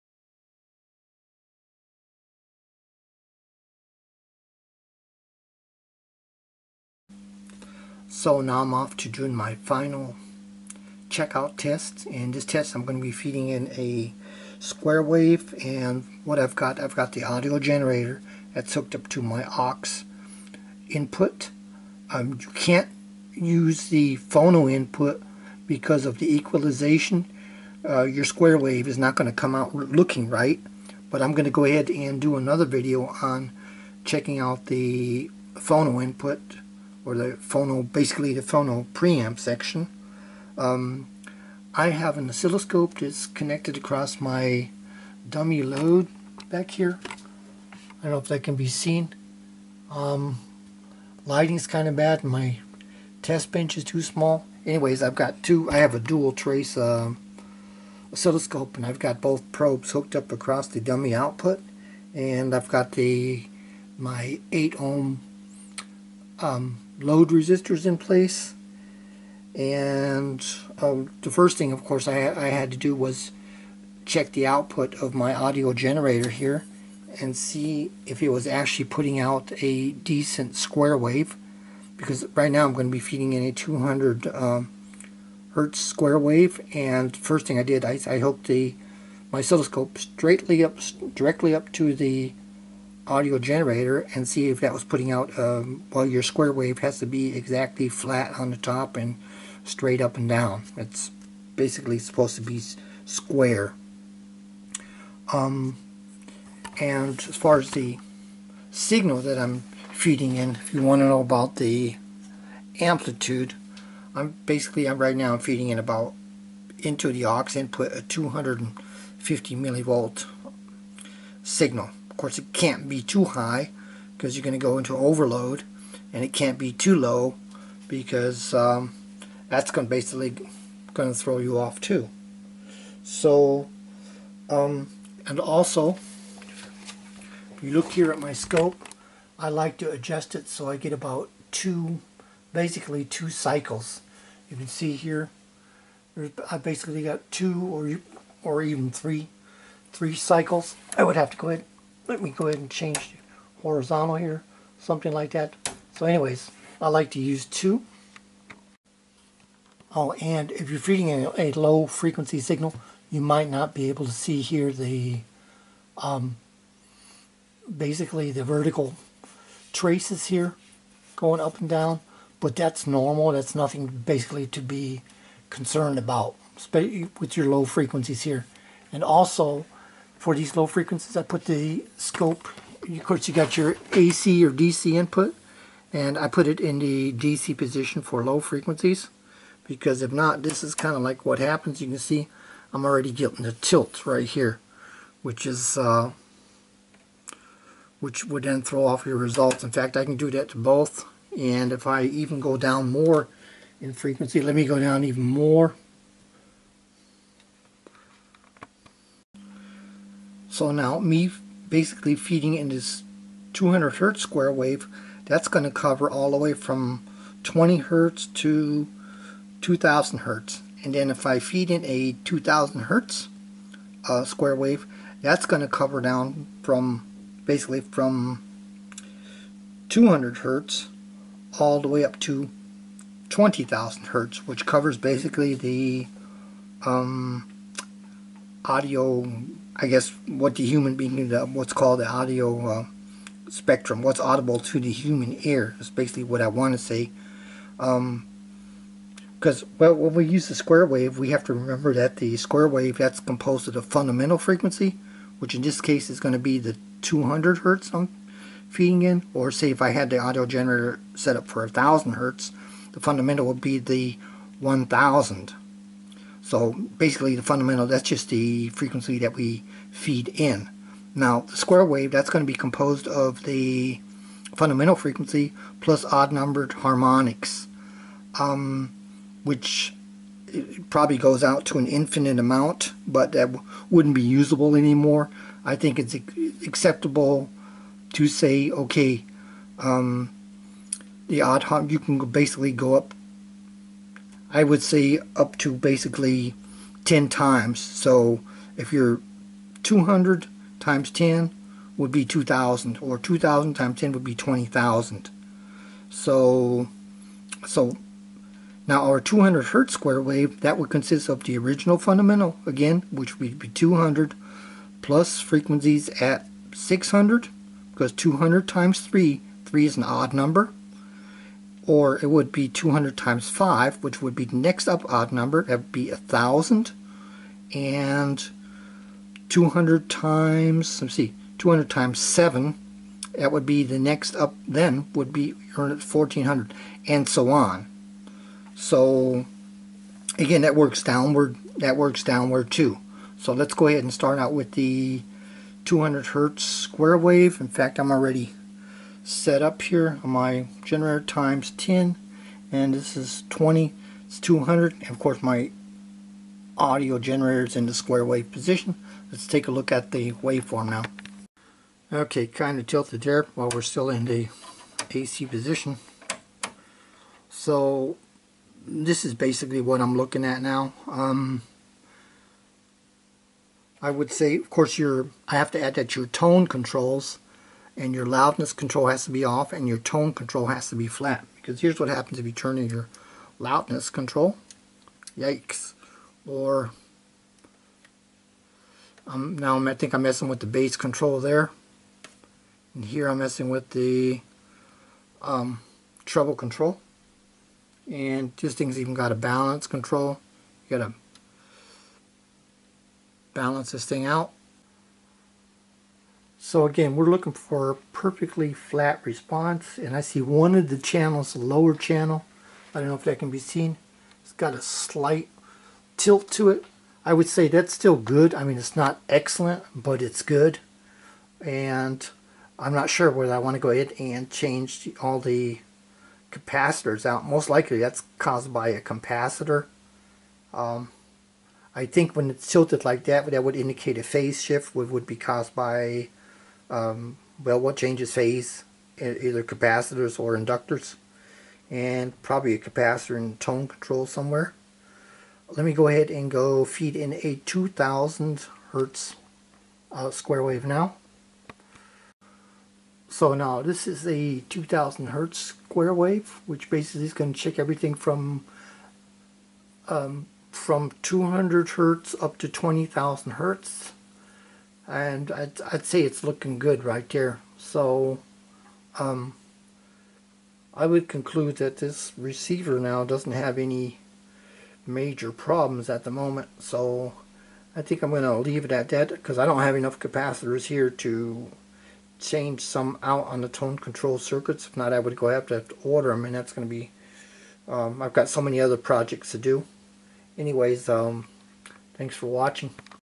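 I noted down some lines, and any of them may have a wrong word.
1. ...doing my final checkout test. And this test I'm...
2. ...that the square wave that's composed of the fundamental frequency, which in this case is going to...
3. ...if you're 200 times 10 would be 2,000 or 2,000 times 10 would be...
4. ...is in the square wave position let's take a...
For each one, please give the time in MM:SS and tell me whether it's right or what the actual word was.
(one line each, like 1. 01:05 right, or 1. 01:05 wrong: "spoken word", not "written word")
1. 00:09 right
2. 04:11 right
3. 04:58 right
4. 05:57 right.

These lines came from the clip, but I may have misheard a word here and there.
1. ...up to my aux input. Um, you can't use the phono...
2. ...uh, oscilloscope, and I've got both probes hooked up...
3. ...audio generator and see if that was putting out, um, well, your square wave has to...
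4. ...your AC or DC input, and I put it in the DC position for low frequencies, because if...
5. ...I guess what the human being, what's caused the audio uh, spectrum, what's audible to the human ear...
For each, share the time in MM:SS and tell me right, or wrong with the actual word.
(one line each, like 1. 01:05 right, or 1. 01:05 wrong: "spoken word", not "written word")
1. 00:18 right
2. 00:56 right
3. 01:33 right
4. 03:03 right
5. 03:59 wrong: "called", not "caused".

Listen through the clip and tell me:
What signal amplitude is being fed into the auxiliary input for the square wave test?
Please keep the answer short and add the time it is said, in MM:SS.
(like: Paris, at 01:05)
250 millivolts, at 01:58.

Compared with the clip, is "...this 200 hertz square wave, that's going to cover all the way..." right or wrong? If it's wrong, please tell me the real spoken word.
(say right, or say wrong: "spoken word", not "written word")
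right.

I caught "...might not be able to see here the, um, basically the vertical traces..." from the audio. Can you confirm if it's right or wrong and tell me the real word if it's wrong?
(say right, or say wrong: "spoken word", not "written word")
right.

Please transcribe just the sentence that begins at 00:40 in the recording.
Um, I have an oscilloscope that's connected across my dummy load back here.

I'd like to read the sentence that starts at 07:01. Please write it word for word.
And I'm not sure whether I want to go ahead and change all the capacitors out.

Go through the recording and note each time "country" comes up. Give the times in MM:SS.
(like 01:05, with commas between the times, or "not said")
not said.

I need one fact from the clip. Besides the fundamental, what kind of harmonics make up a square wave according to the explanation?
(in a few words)
odd numbered harmonics.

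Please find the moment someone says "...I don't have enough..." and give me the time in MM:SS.
07:59.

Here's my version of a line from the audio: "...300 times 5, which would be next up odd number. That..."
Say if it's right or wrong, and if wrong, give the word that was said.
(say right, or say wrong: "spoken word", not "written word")
wrong: "200", not "300".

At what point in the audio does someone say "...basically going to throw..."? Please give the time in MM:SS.
02:09.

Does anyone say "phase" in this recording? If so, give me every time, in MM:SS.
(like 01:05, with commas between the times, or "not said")
07:14, 07:18.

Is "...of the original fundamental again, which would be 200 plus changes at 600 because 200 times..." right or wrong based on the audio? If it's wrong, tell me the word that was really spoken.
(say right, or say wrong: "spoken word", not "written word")
wrong: "frequencies", not "changes".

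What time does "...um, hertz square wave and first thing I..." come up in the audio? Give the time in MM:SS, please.
01:24.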